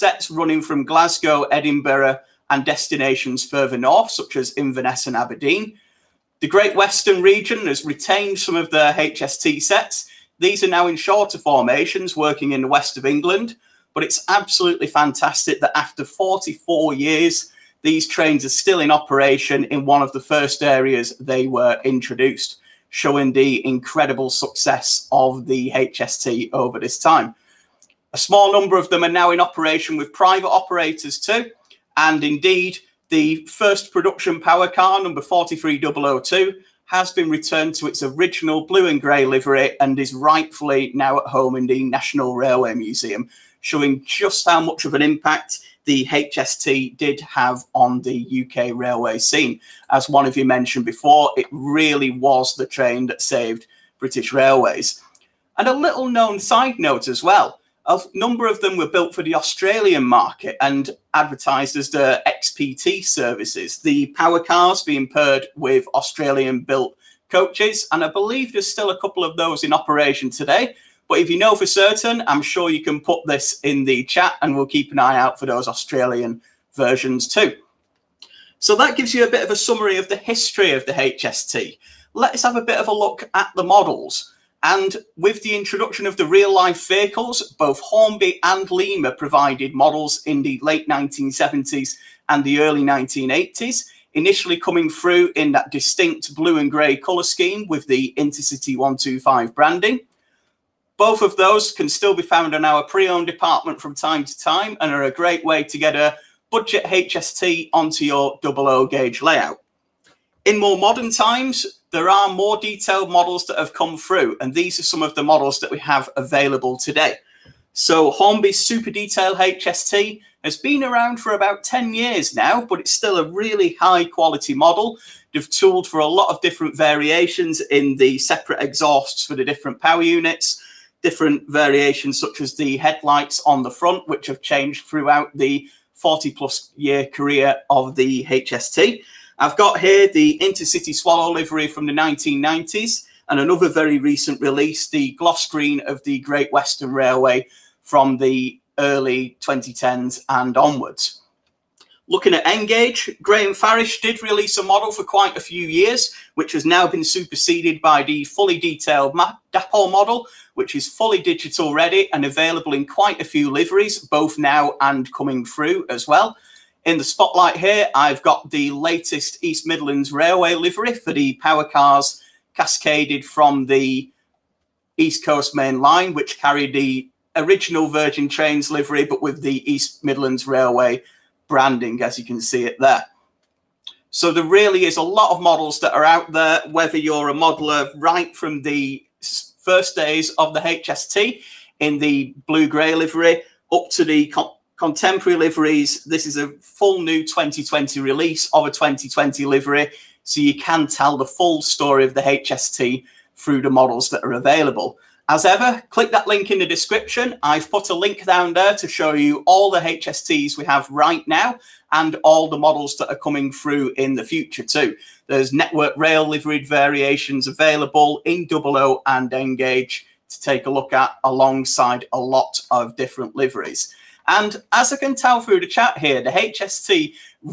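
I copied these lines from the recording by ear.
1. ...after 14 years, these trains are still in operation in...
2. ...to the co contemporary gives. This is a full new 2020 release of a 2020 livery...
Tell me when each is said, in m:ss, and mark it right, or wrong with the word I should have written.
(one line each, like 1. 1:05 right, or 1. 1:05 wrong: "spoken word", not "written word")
1. 0:15 wrong: "44", not "14"
2. 3:13 wrong: "liveries", not "gives".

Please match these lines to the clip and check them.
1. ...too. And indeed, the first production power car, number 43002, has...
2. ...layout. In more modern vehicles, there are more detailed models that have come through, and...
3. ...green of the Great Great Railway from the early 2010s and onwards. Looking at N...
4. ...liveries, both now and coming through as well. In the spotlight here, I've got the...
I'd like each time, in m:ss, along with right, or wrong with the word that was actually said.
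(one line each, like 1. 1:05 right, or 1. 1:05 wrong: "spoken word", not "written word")
1. 0:31 right
2. 1:49 wrong: "times", not "vehicles"
3. 2:25 wrong: "Western", not "Great"
4. 2:43 right.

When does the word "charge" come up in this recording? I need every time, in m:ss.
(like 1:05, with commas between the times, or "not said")
not said.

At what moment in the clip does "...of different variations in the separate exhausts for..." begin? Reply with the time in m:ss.
2:06.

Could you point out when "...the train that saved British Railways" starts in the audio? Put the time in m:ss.
0:52.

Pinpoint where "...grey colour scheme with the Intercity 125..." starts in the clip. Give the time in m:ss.
1:36.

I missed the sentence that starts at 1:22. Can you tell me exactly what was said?
Let's have a bit of a look at the models.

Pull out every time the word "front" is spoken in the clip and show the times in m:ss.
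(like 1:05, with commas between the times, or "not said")
2:13.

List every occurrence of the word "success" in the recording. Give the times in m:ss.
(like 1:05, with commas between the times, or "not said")
0:24.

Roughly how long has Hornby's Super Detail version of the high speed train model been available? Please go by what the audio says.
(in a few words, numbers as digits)
About 10 years.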